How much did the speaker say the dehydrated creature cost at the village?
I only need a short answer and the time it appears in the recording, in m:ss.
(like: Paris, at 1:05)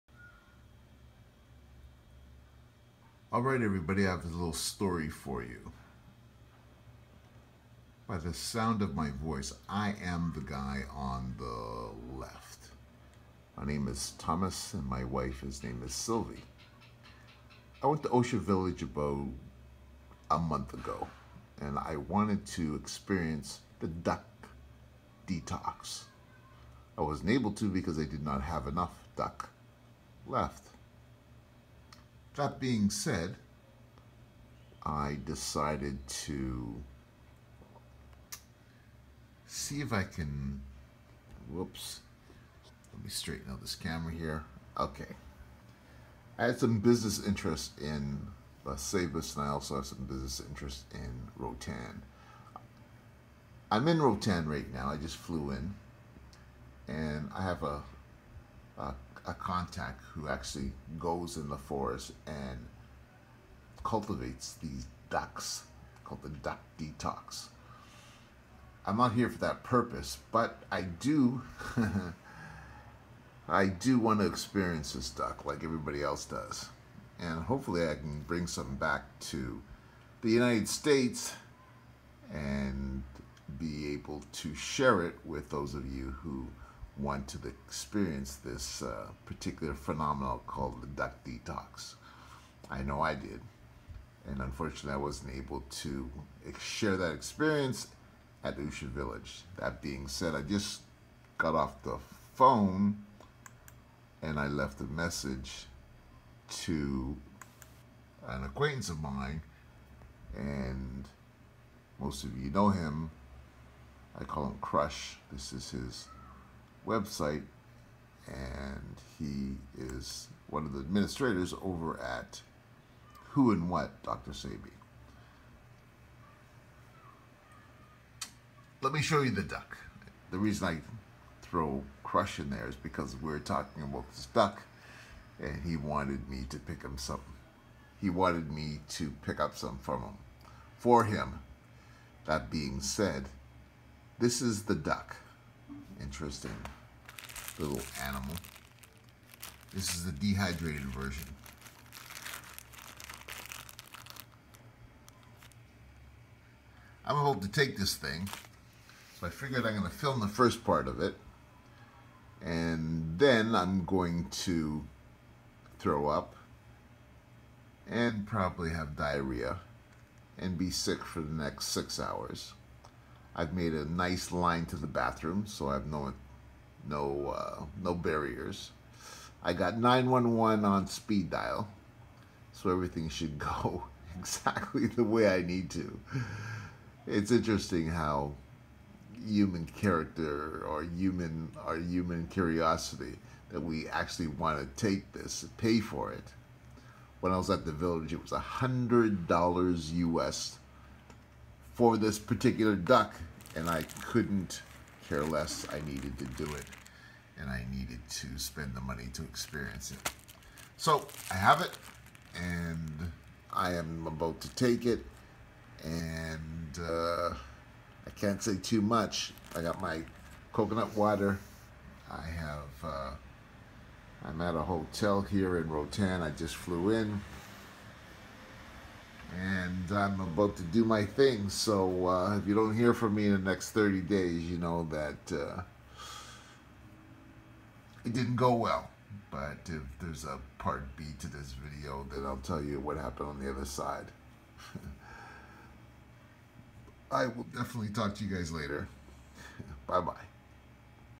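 $100, at 3:18.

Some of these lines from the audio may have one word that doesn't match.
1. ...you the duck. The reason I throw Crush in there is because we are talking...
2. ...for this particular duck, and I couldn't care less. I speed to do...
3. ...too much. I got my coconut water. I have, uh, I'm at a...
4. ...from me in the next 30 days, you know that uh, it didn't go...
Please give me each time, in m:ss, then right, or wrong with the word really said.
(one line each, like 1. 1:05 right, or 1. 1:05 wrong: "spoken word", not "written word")
1. 2:09 right
2. 3:21 wrong: "needed", not "speed"
3. 3:38 right
4. 3:52 right.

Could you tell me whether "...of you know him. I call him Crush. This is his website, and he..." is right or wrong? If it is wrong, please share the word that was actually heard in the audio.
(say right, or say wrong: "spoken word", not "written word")
right.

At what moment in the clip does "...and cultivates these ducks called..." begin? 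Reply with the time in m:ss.
1:02.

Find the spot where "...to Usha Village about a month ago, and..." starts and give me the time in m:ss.
0:18.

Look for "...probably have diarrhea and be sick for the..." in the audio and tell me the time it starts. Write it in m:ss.
2:48.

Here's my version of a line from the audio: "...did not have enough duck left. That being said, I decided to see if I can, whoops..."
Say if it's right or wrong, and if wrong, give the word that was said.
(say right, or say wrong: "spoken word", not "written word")
right.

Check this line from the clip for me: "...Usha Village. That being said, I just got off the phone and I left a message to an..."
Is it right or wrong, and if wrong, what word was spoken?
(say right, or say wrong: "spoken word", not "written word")
right.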